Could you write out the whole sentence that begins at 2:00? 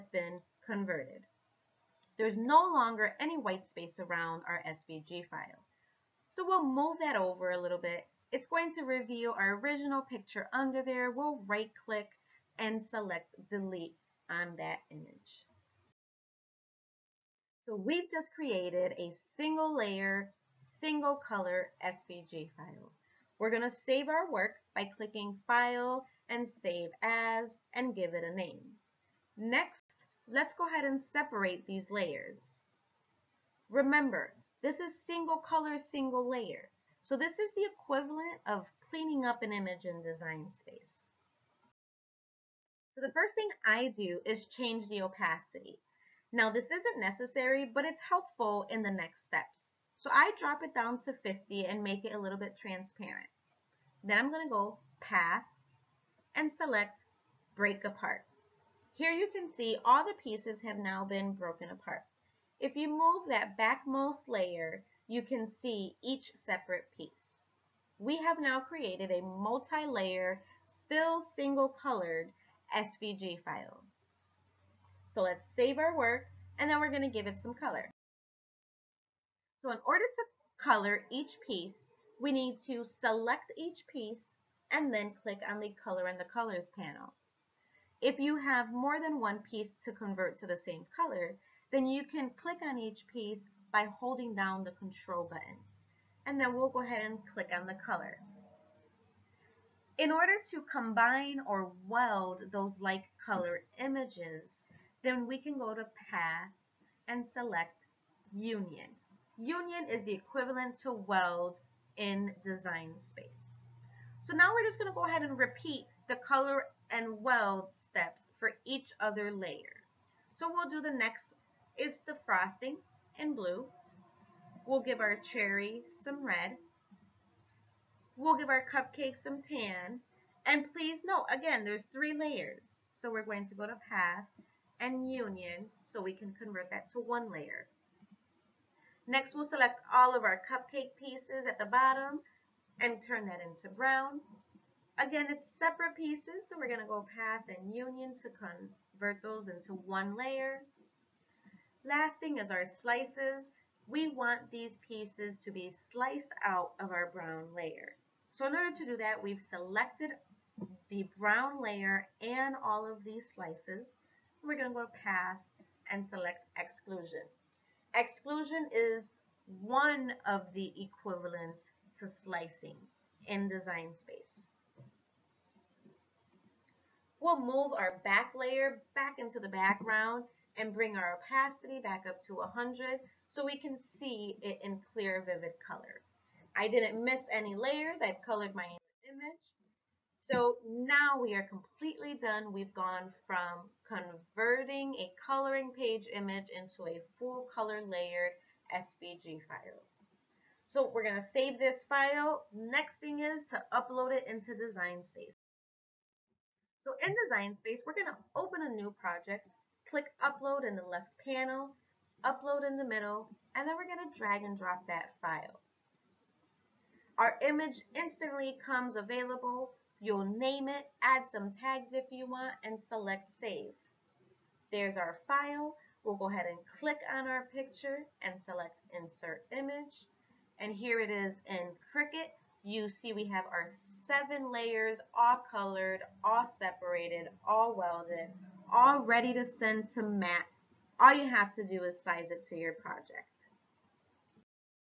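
So we'll do the next is the frosting in blue.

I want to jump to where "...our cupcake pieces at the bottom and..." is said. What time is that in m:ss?
2:20.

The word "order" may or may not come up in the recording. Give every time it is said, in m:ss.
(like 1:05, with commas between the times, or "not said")
1:19, 1:40, 2:38.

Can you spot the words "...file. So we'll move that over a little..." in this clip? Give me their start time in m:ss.
0:05.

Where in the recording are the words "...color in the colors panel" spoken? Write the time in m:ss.
1:25.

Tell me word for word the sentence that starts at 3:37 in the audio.
Our image instantly comes available You'll name it, add some tags if you want, and select save.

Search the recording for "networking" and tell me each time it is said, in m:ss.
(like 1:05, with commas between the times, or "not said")
not said.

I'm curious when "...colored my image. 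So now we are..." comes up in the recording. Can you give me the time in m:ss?
3:08.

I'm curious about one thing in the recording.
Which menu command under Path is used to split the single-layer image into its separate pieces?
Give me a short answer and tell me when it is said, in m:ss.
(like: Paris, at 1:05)
Break Apart, at 0:57.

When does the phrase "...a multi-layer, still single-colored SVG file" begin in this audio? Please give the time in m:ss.
1:09.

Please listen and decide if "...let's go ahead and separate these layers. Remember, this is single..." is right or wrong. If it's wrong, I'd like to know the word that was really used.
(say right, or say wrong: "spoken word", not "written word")
right.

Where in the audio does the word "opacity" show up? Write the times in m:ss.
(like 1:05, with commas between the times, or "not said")
0:45, 3:01.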